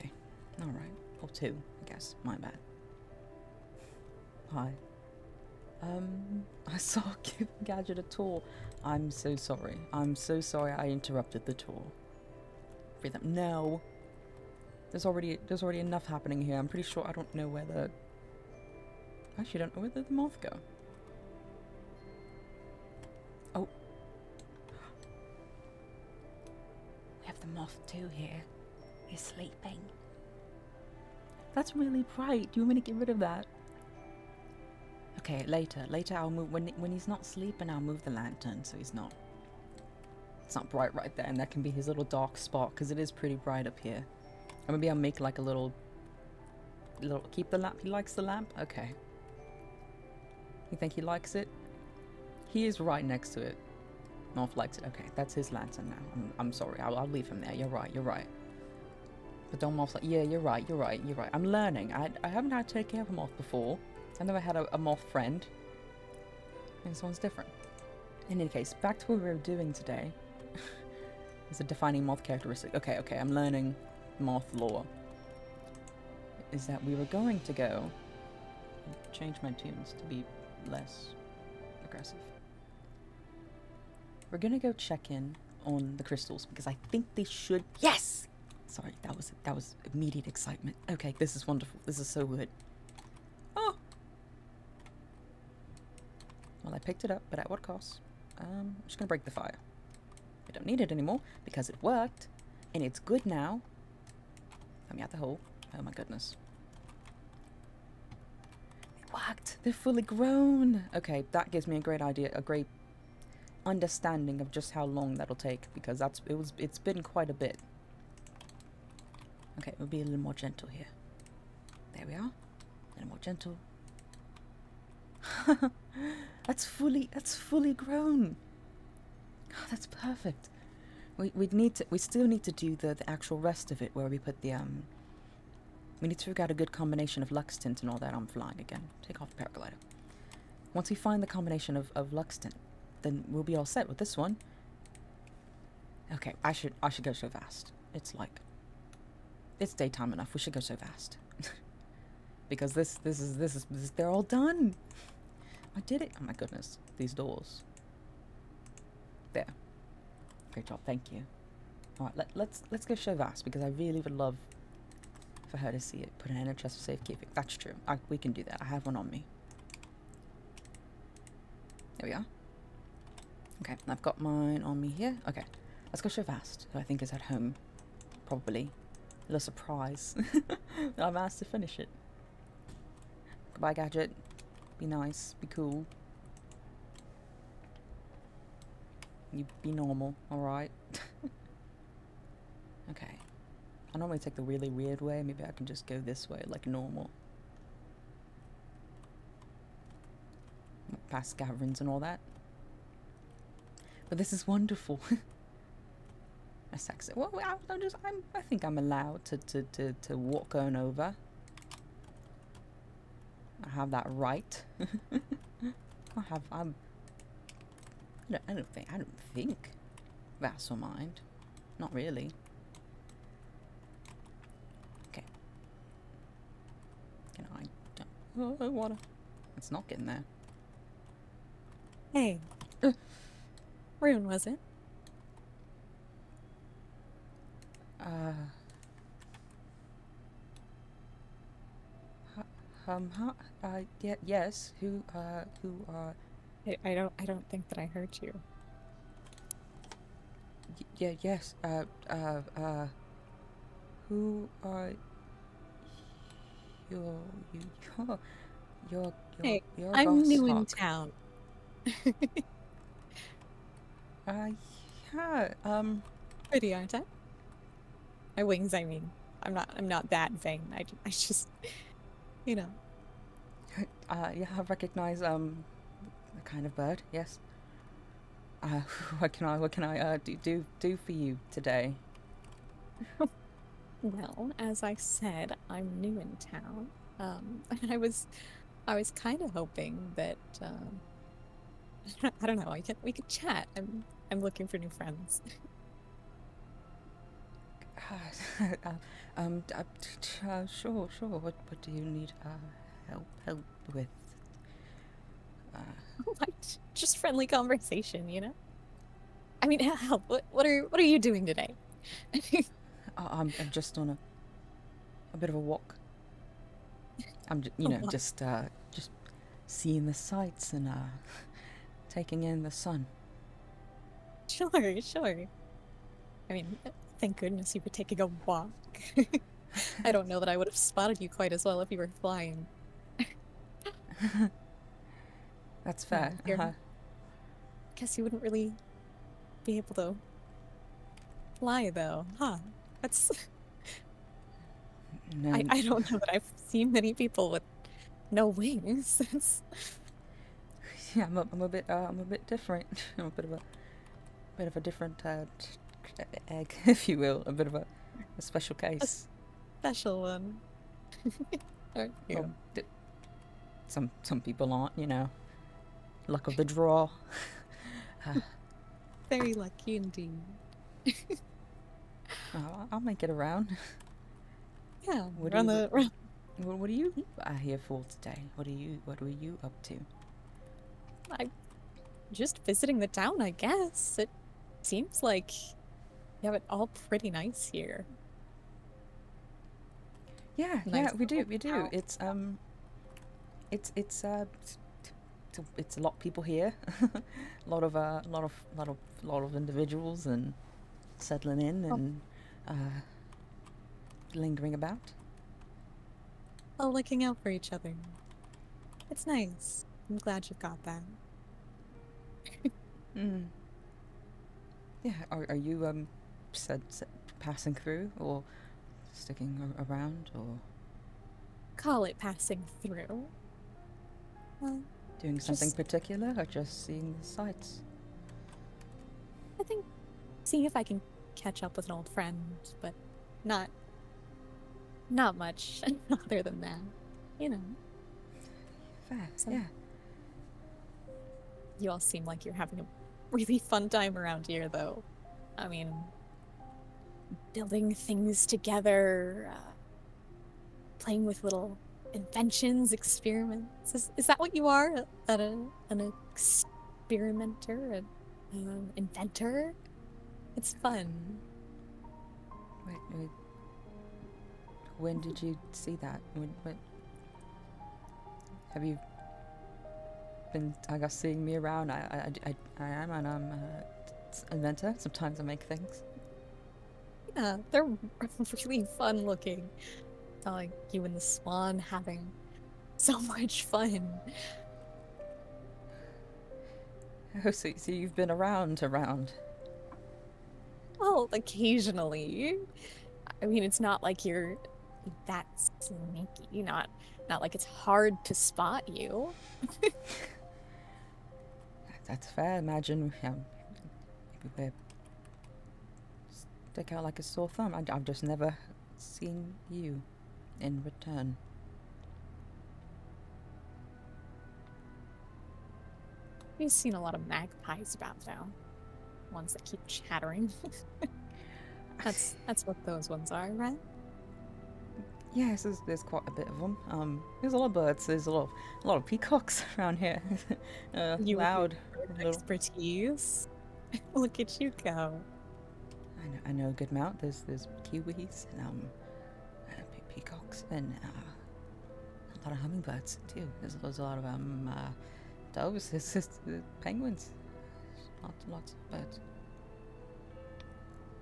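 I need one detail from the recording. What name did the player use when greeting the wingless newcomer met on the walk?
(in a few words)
Rune.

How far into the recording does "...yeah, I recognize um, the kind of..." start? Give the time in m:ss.
4:34.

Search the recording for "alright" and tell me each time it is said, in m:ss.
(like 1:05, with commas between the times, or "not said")
0:00, 3:10.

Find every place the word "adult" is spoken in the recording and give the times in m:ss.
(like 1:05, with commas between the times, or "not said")
not said.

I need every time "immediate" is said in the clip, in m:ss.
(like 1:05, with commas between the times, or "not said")
1:29.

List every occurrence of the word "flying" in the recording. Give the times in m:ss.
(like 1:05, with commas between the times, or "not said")
2:18, 5:32.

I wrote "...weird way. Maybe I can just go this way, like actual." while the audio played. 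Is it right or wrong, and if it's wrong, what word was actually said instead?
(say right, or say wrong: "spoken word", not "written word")
wrong: "normal", not "actual".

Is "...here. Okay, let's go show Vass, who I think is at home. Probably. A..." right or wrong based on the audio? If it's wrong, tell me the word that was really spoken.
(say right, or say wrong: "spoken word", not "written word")
right.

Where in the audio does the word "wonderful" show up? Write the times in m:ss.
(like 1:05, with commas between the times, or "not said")
1:31, 3:24.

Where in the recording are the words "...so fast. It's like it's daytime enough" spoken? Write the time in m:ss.
2:27.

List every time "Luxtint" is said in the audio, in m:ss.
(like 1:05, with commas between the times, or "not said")
2:17, 2:22.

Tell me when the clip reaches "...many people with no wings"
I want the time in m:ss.
5:46.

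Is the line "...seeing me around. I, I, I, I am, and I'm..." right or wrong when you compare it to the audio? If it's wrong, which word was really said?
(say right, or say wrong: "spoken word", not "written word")
right.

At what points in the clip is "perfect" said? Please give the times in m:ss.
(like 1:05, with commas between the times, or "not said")
2:09.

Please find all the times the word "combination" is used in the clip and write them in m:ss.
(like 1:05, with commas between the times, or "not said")
2:16, 2:21.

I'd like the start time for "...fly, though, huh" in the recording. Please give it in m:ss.
5:41.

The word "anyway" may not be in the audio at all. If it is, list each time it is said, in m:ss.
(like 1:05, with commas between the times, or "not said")
not said.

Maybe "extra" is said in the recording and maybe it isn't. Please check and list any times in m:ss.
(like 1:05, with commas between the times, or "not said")
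not said.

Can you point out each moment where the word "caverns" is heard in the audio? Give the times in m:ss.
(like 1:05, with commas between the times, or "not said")
3:21.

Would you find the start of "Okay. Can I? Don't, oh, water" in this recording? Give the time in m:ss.
3:45.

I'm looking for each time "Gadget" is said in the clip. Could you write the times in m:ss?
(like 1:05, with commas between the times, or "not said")
0:07, 3:03.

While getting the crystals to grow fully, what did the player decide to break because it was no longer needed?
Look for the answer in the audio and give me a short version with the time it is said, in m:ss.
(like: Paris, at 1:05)
the fire, at 1:39.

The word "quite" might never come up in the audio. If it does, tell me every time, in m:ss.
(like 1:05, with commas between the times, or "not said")
1:57, 5:31, 8:46.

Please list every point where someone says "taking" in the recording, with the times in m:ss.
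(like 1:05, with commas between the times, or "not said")
5:22, 5:27.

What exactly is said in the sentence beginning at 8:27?
I, I've just never seen you in return.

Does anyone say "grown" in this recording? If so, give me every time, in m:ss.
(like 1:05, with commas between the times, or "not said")
1:50, 2:07.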